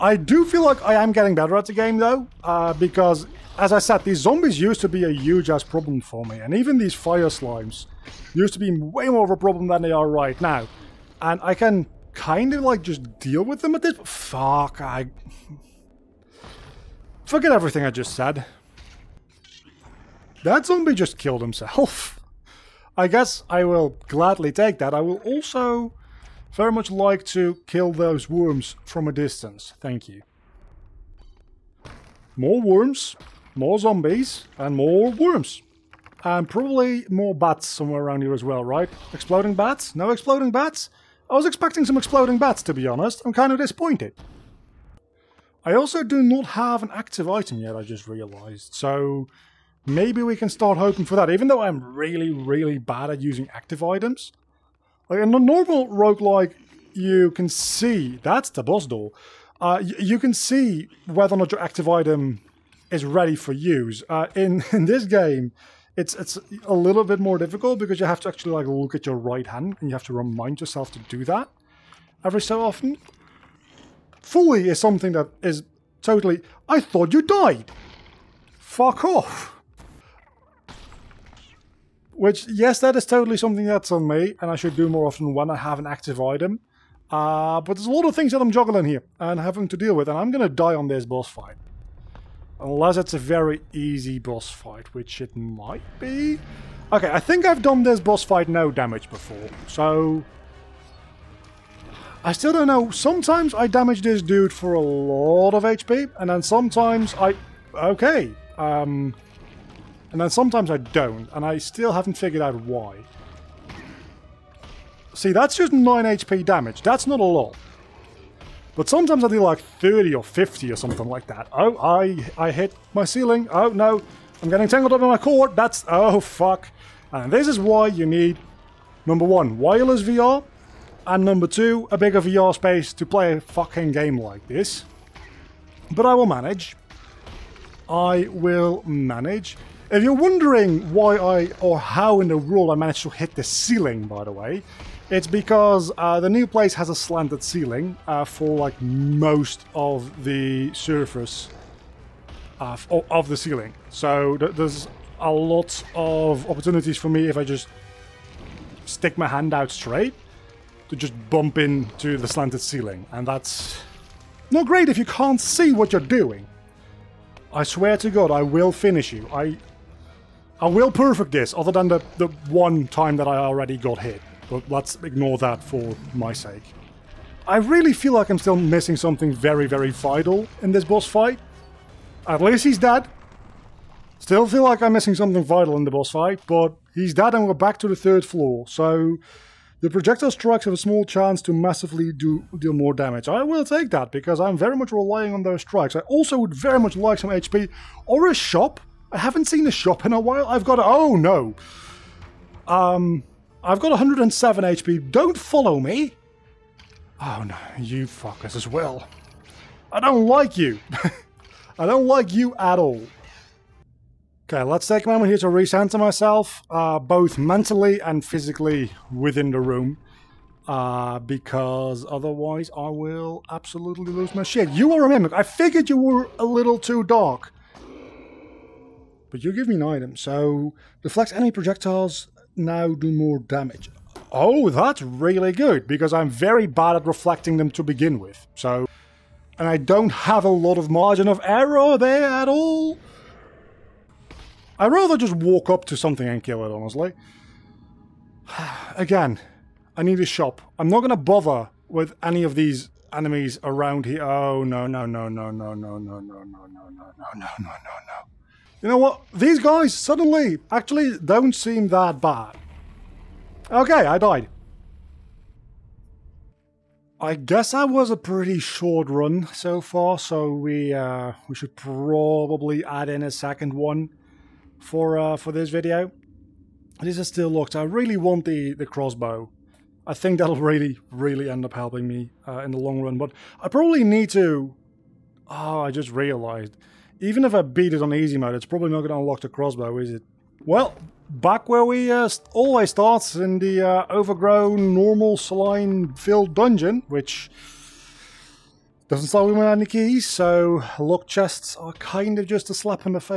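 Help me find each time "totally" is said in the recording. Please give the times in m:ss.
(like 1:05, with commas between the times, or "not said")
1:16, 1:23.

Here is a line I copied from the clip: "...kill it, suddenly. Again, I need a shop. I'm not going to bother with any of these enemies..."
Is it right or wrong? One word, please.
wrong.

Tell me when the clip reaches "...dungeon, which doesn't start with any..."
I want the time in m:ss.
4:56.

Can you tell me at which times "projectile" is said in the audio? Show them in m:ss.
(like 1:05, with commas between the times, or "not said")
3:09, 3:51.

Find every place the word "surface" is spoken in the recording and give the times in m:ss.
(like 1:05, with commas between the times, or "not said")
2:30.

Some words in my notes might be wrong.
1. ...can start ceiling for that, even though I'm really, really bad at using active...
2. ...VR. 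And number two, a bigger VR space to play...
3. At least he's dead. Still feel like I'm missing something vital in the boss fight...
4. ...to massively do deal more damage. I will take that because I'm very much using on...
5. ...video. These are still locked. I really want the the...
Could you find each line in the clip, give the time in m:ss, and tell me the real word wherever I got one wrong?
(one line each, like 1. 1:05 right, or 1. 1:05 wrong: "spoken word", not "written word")
1. 0:50 wrong: "hoping", not "ceiling"
2. 2:10 right
3. 3:02 right
4. 3:11 wrong: "relying", not "using"
5. 4:35 right.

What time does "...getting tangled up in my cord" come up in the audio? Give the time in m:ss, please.
2:04.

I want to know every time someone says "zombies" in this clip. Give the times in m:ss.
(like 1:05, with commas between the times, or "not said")
0:04, 0:20, 0:33.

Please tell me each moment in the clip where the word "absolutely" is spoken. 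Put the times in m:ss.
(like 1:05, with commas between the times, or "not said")
3:43.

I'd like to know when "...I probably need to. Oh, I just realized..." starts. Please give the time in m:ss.
4:43.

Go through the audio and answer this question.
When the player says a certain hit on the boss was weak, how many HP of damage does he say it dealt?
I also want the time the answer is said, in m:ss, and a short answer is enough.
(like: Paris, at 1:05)
9, at 1:55.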